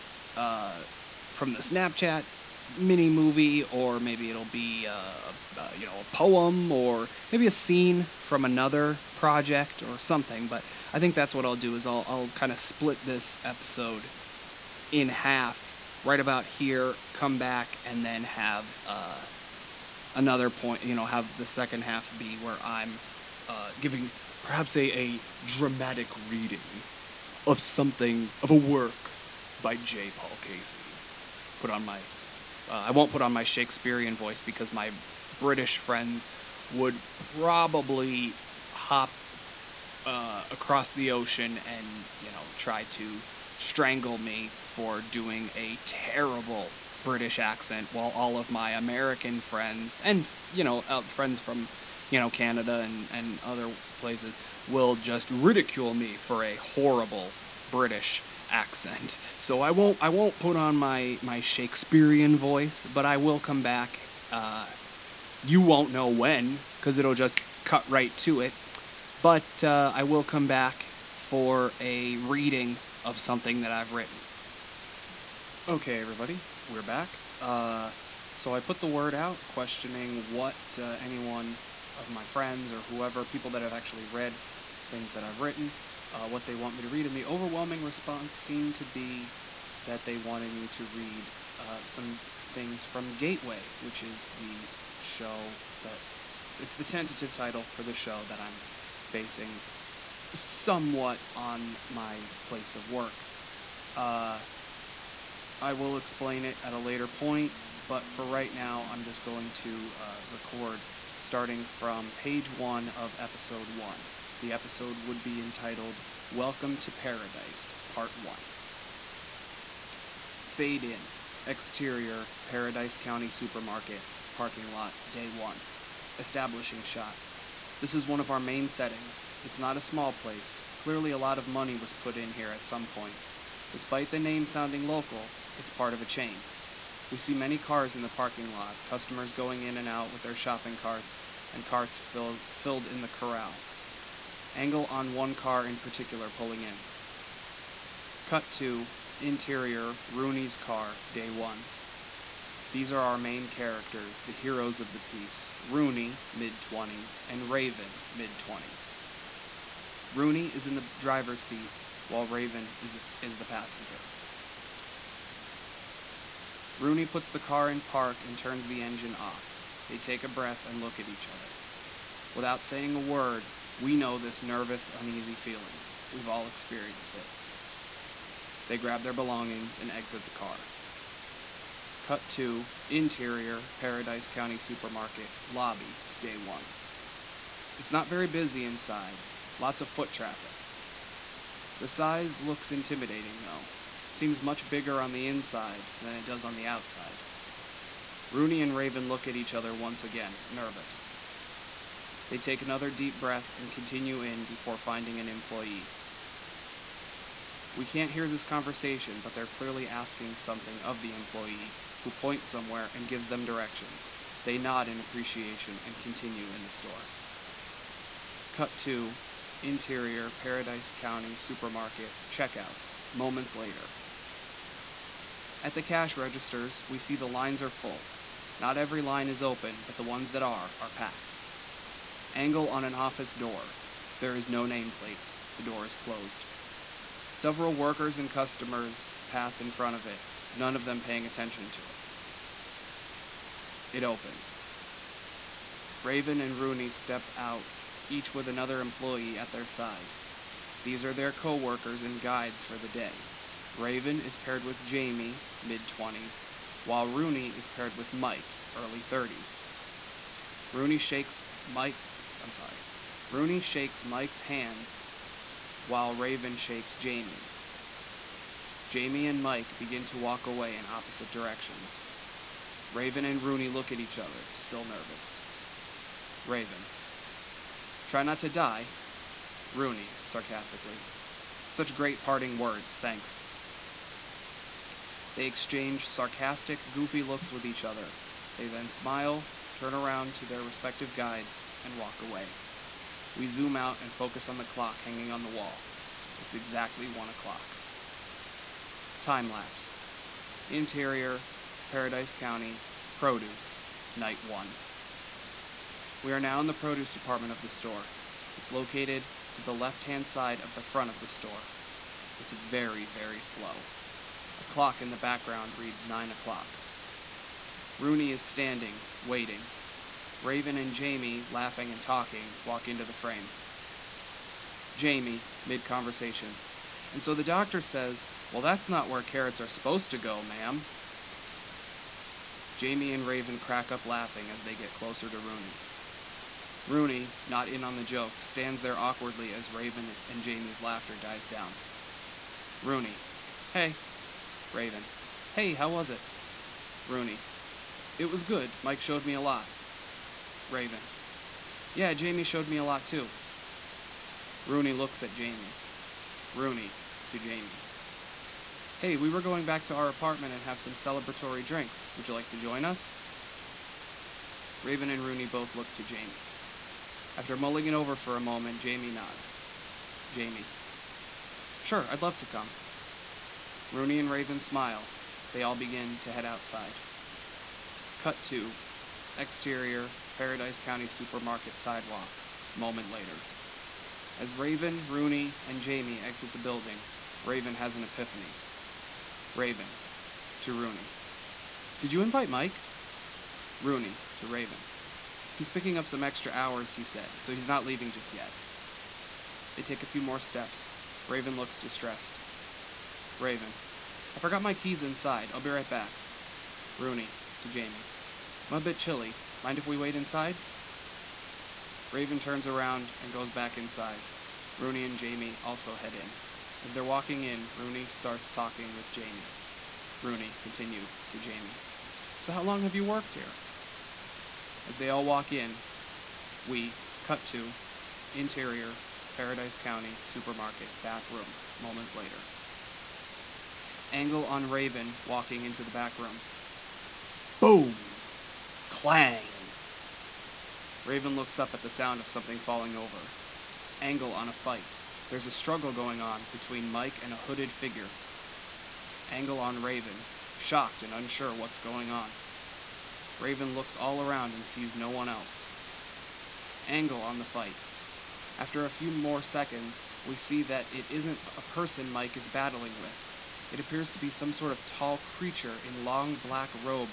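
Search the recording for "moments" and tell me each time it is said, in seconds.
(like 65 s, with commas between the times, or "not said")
223 s, 368 s, 382 s, 431 s.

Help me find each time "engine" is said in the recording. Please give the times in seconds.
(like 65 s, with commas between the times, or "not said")
168 s.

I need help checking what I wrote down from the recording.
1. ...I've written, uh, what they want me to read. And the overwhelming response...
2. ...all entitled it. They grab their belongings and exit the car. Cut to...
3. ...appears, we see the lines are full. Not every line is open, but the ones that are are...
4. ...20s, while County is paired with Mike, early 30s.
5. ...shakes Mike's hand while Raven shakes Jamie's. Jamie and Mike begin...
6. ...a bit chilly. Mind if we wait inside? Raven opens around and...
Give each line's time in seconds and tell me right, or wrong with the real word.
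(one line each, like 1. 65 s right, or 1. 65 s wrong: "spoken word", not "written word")
1. 85 s right
2. 176 s wrong: "experienced", not "entitled"
3. 226 s wrong: "registers", not "appears"
4. 255 s wrong: "Rooney", not "County"
5. 263 s right
6. 408 s wrong: "turns", not "opens".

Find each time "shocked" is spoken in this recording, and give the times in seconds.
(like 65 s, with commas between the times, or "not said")
450 s.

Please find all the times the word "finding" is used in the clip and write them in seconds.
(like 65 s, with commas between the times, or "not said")
204 s.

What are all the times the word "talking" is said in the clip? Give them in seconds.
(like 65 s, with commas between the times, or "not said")
322 s, 418 s.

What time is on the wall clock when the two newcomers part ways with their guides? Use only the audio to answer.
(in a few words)
1 o'clock.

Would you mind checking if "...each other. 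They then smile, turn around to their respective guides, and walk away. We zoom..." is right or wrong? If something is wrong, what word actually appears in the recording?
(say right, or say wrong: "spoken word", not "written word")
right.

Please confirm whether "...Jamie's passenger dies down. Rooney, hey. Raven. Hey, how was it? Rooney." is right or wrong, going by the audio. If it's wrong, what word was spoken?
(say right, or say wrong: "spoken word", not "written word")
wrong: "laughter", not "passenger".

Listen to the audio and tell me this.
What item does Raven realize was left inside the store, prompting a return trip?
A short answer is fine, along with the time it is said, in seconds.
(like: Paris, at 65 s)
keys, at 404 s.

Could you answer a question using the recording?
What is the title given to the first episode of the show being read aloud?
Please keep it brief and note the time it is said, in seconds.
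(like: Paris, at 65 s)
Welcome to Paradise, Part 1, at 116 s.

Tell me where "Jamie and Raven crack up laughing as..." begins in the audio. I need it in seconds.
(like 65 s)
332 s.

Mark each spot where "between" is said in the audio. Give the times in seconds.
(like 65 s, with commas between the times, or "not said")
446 s.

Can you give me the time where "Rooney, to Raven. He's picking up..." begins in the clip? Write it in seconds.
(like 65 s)
393 s.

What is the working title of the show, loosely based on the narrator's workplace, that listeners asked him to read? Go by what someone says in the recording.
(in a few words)
Gateway.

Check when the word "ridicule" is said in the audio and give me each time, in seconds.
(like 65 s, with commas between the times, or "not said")
55 s.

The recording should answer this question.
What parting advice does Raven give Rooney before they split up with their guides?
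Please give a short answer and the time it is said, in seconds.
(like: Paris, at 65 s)
Try not to die, at 278 s.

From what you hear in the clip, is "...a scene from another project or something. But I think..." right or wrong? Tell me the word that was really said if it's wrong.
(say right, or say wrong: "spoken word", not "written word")
right.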